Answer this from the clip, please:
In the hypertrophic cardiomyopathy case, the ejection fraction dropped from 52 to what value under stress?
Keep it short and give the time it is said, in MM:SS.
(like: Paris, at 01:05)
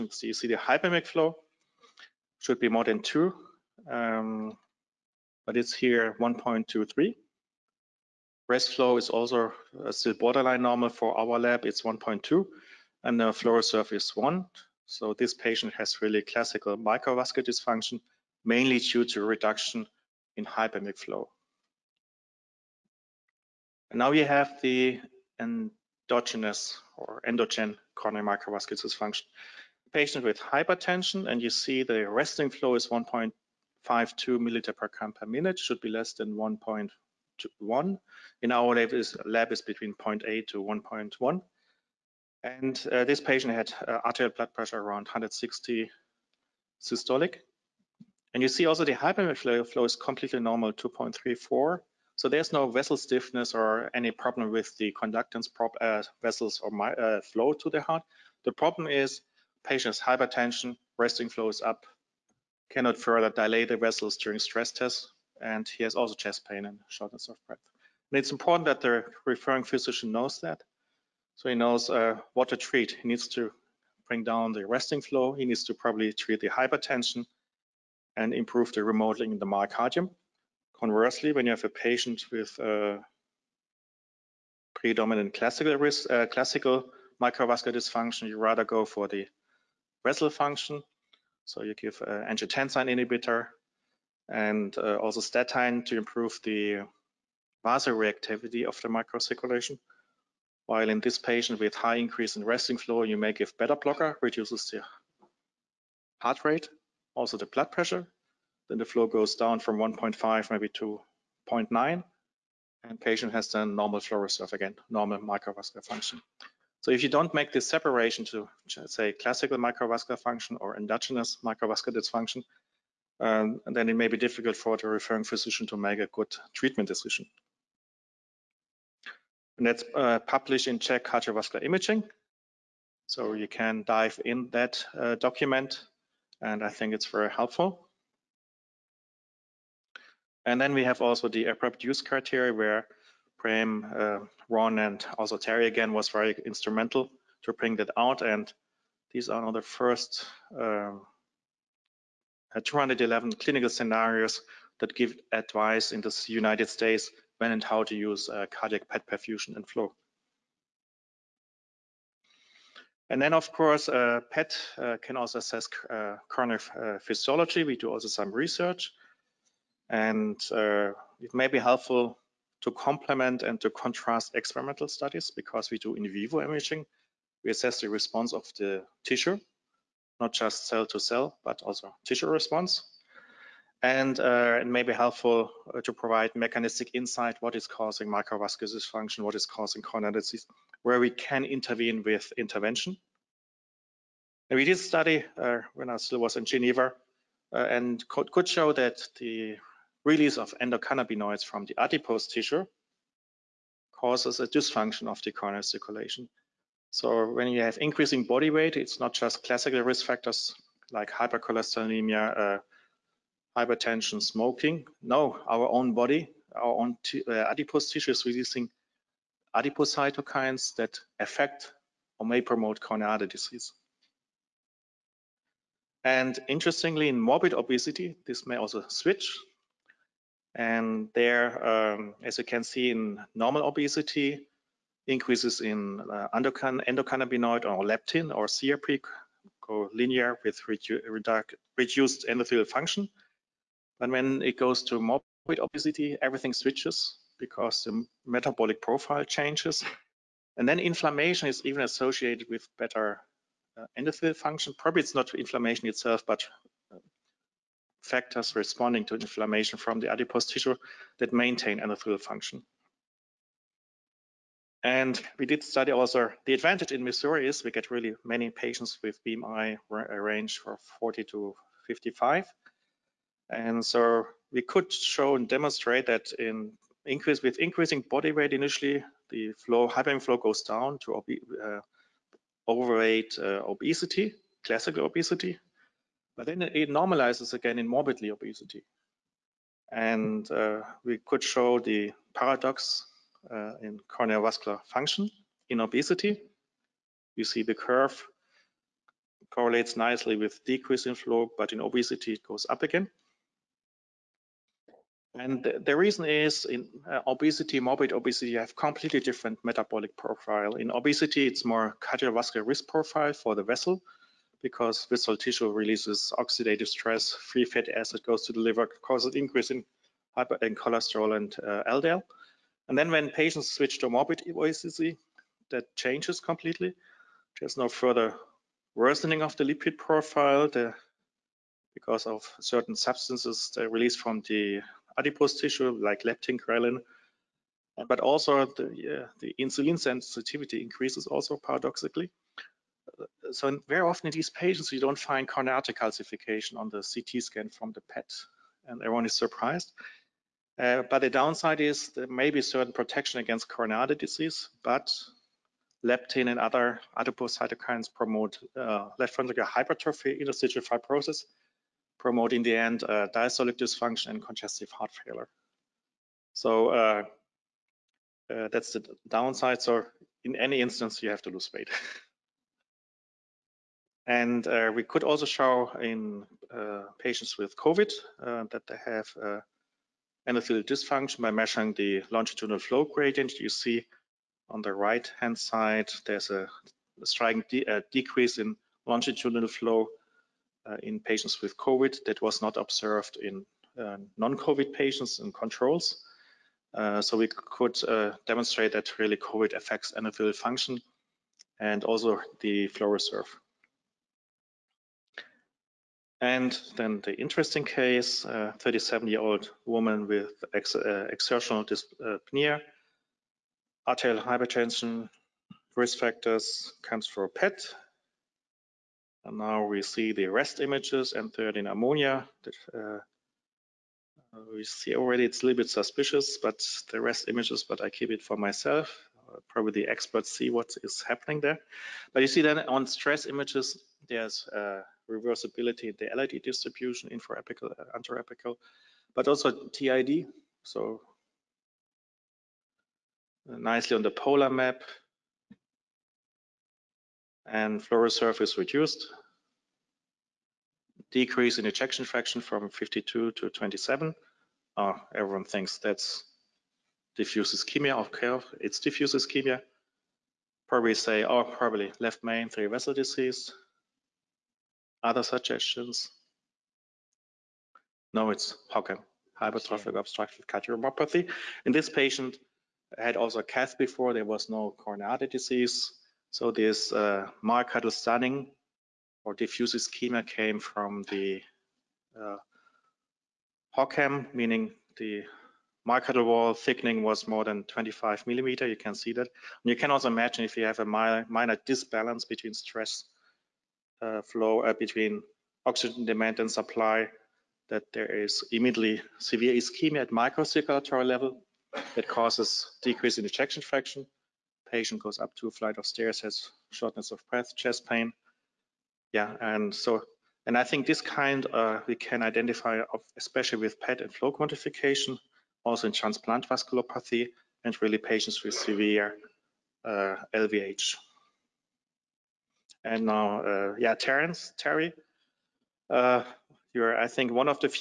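27, at 07:33.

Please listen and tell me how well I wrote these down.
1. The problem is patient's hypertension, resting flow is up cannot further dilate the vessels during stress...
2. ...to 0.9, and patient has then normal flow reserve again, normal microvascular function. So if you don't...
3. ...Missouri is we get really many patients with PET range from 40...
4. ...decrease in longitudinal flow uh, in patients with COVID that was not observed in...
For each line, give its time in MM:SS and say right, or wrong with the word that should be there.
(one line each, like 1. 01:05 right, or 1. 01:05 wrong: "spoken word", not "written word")
1. 00:58 right
2. 01:50 right
3. 04:27 wrong: "BMI", not "PET"
4. 06:28 right.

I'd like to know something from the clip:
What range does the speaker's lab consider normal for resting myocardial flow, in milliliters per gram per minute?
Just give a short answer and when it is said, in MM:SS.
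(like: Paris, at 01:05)
0.8 to 1.1, at 00:39.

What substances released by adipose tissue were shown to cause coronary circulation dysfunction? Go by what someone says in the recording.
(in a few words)
endocannabinoids.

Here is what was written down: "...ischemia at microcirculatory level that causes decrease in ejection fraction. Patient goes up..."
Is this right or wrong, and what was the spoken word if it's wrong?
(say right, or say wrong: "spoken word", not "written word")
right.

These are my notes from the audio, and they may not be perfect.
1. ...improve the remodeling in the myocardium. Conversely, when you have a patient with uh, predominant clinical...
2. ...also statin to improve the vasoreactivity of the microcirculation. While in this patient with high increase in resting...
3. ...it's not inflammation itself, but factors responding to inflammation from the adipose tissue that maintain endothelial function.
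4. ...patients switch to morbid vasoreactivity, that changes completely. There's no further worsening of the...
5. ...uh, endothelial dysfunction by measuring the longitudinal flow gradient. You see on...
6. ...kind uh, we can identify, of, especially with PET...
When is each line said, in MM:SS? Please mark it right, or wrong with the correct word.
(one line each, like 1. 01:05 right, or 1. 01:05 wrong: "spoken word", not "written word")
1. 01:18 wrong: "classical", not "clinical"
2. 01:34 right
3. 04:15 right
4. 05:23 wrong: "obesity", not "vasoreactivity"
5. 06:19 right
6. 08:31 right.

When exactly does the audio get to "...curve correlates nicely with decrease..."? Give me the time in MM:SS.
04:57.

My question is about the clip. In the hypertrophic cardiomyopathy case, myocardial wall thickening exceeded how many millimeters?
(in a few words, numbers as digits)
25.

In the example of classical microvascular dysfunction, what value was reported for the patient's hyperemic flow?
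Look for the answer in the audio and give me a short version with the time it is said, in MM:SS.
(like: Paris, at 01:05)
1.23, at 00:06.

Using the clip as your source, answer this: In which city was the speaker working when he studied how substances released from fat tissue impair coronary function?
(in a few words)
Geneva.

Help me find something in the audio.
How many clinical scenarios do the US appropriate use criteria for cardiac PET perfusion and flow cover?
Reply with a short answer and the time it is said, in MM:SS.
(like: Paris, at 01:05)
211, at 02:32.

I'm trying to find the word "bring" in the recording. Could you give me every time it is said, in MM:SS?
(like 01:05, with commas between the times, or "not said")
01:14, 02:27.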